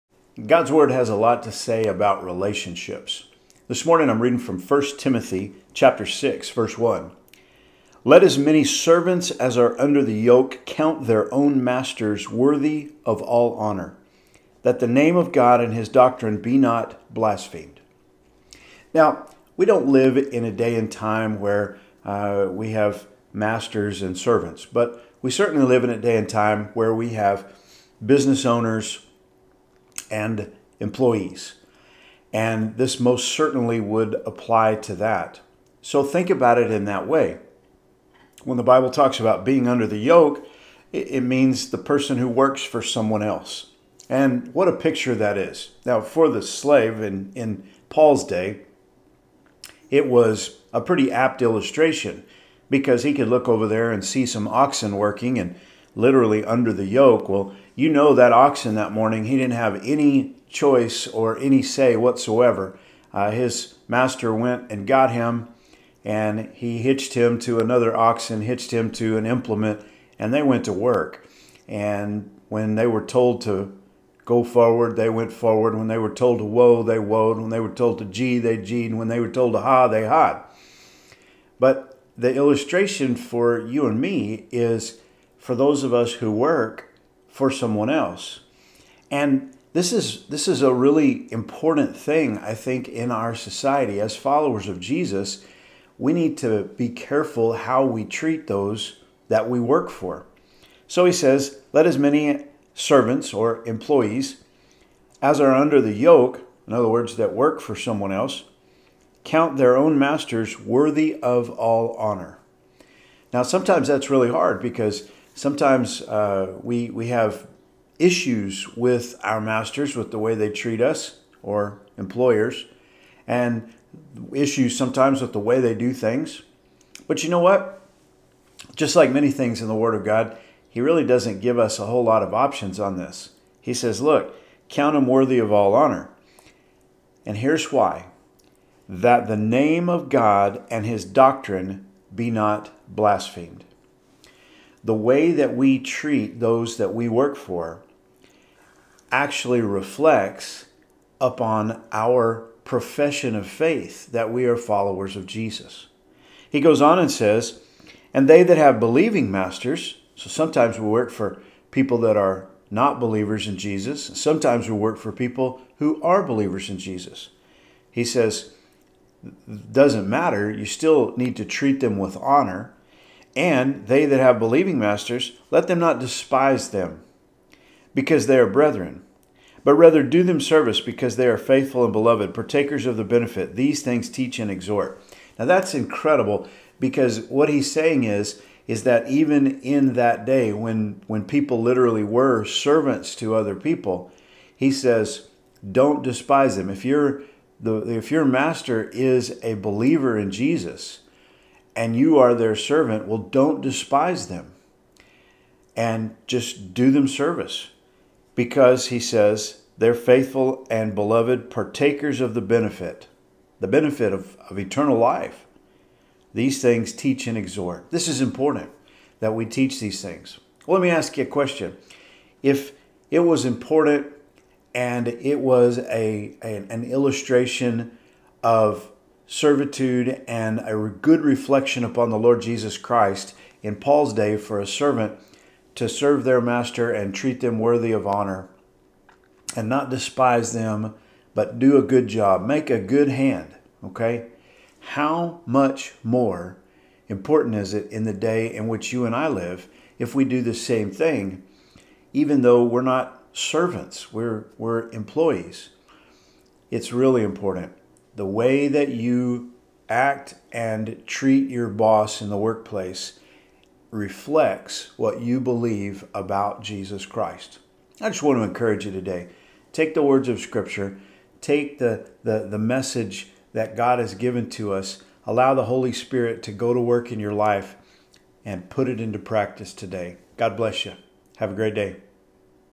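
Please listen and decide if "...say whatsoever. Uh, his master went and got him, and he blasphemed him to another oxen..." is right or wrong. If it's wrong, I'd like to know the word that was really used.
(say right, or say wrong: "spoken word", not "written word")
wrong: "hitched", not "blasphemed".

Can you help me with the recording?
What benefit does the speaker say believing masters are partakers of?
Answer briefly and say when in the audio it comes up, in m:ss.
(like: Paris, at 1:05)
Eternal life, at 3:34.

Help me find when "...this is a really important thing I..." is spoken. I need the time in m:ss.
1:30.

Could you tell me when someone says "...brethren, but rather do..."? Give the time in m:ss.
2:58.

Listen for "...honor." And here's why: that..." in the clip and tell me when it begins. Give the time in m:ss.
2:15.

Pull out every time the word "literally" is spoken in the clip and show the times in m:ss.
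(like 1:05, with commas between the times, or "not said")
0:55, 3:11.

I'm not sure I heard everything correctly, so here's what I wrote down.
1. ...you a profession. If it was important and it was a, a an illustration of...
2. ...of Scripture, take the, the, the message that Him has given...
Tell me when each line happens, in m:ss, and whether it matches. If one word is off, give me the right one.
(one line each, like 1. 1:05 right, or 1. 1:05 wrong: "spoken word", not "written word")
1. 3:41 wrong: "question", not "profession"
2. 4:30 wrong: "God", not "Him".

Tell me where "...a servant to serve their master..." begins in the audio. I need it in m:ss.
3:54.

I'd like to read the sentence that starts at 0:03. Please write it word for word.
This morning I'm reading from 1 Timothy chapter 6 verse 1.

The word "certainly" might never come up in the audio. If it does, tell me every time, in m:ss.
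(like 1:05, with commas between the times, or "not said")
0:25, 0:33.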